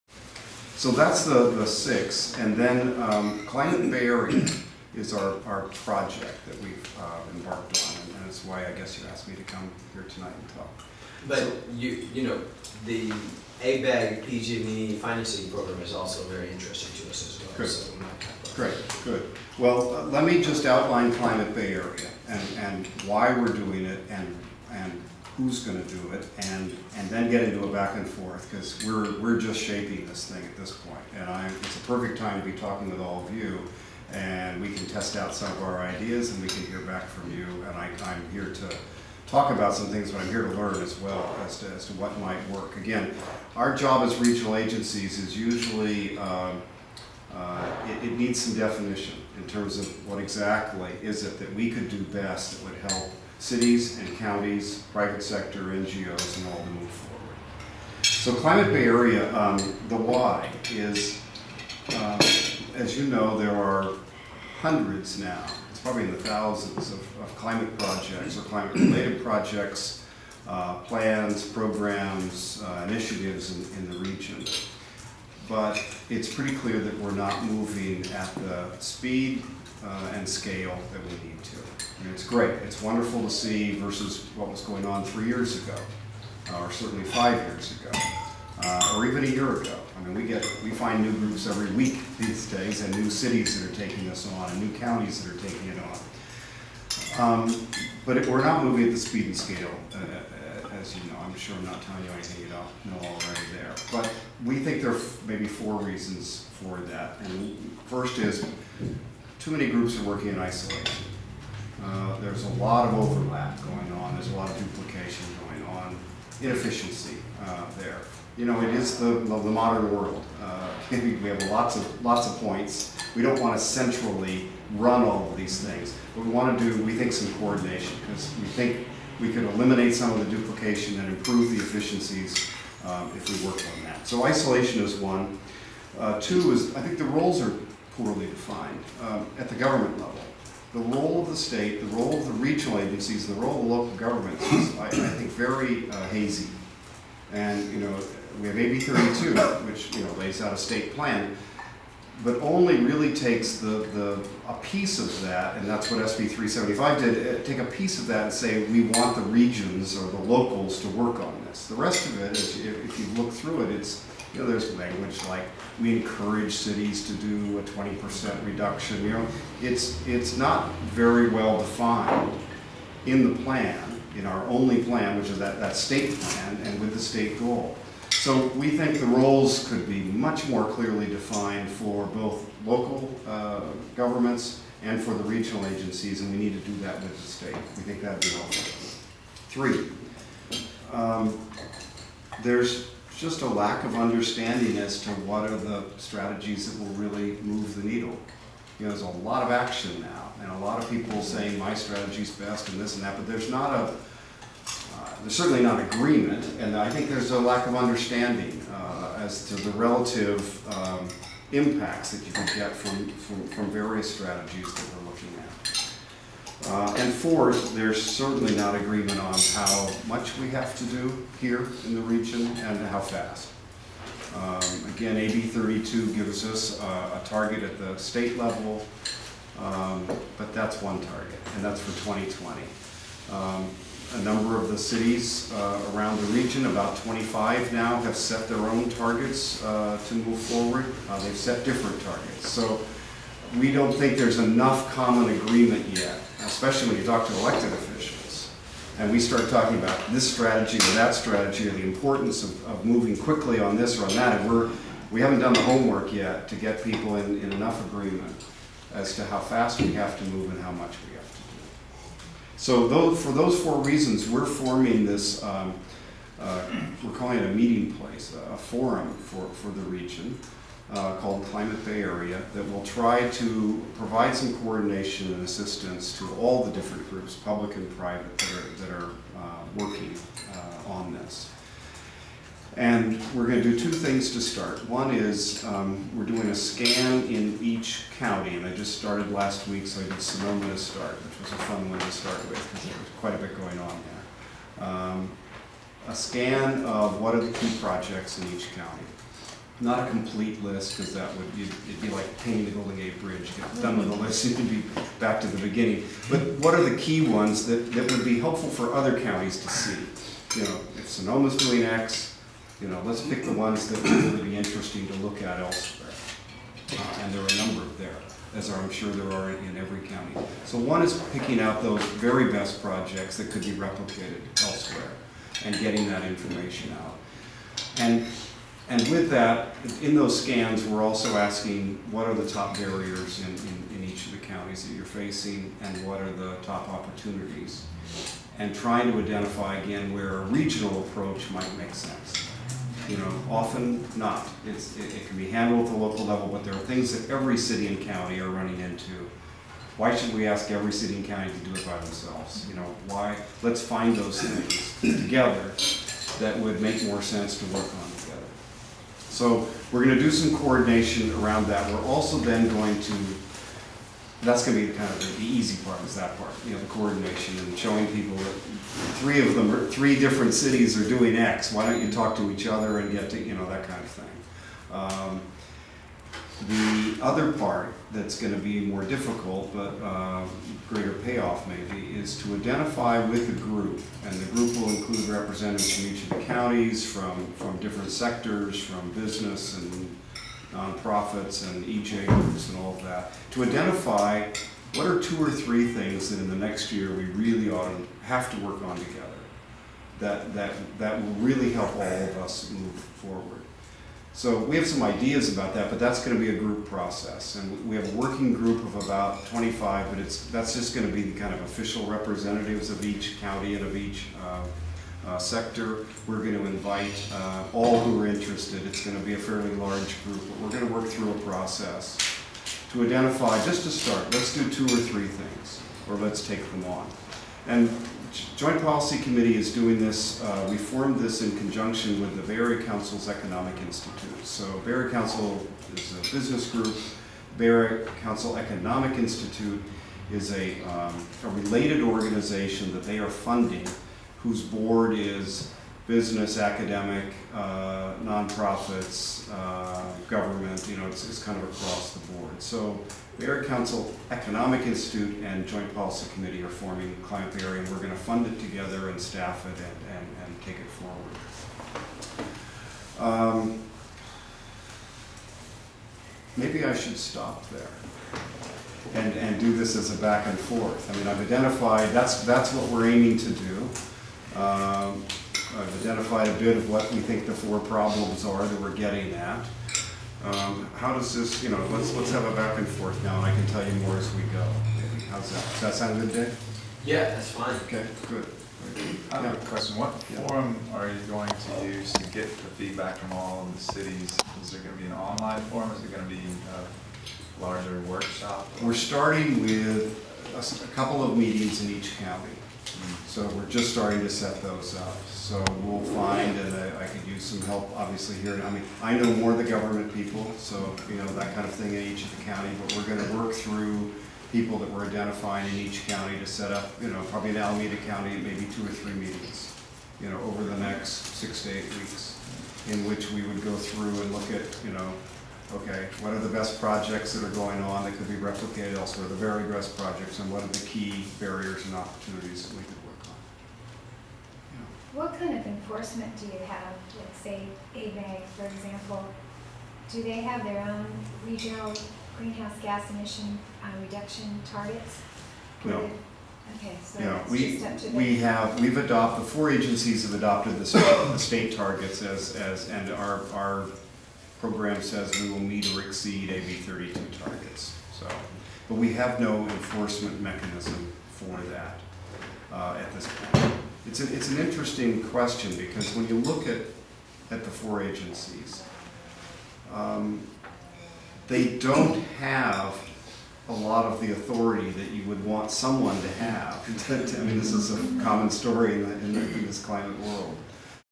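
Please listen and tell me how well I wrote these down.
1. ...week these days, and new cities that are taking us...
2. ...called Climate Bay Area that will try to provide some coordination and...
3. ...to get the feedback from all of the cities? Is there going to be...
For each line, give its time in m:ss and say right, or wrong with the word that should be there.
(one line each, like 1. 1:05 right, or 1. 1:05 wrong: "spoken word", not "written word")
1. 1:31 right
2. 4:31 right
3. 8:12 right.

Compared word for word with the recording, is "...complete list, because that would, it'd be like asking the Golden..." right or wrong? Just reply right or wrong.
wrong.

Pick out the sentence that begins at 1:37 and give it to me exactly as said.
Um, but it, we're not moving at the speed and scale, uh, uh, uh as you know.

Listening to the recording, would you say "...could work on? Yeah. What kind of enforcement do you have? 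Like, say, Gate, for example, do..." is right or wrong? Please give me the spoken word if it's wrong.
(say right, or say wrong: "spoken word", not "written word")
wrong: "ABAG", not "Gate".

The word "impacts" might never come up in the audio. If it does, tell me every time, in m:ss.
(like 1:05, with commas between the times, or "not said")
3:31.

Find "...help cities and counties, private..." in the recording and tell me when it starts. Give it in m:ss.
0:52.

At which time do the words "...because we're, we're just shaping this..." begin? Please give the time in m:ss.
0:28.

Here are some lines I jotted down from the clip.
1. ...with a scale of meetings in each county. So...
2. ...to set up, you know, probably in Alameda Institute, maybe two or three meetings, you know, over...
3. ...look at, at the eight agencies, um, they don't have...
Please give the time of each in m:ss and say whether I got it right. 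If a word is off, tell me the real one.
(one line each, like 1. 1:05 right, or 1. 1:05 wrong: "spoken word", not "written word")
1. 8:19 wrong: "couple", not "scale"
2. 8:36 wrong: "County", not "Institute"
3. 9:26 wrong: "four", not "eight".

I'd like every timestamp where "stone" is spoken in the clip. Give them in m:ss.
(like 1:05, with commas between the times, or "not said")
not said.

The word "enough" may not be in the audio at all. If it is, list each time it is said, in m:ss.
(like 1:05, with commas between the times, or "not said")
4:04, 4:17.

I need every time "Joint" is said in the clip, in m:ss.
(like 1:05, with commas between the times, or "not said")
7:08, 7:35.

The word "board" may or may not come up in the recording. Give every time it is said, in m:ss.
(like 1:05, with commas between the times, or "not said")
7:24, 7:32.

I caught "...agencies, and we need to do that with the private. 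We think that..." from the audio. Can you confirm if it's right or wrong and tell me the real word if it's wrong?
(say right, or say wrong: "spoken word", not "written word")
wrong: "state", not "private".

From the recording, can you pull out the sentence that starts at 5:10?
You know, if Sonoma's doing X, you know, let's pick the ones that would really be interesting to look at elsewhere.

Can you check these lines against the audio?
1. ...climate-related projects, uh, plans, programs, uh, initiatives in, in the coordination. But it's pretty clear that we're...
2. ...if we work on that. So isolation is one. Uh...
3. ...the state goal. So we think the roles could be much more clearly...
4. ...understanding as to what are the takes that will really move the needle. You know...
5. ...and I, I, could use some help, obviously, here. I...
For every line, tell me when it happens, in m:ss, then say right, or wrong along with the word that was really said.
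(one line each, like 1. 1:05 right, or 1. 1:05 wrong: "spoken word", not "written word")
1. 1:08 wrong: "region", not "coordination"
2. 2:13 right
3. 2:56 right
4. 3:13 wrong: "strategies", not "takes"
5. 8:26 right.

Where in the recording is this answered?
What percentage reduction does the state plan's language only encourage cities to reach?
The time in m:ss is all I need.
2:47.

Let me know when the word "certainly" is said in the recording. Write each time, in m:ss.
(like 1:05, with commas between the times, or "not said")
1:26, 3:25, 3:38.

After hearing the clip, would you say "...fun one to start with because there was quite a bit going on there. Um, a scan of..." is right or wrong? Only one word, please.
right.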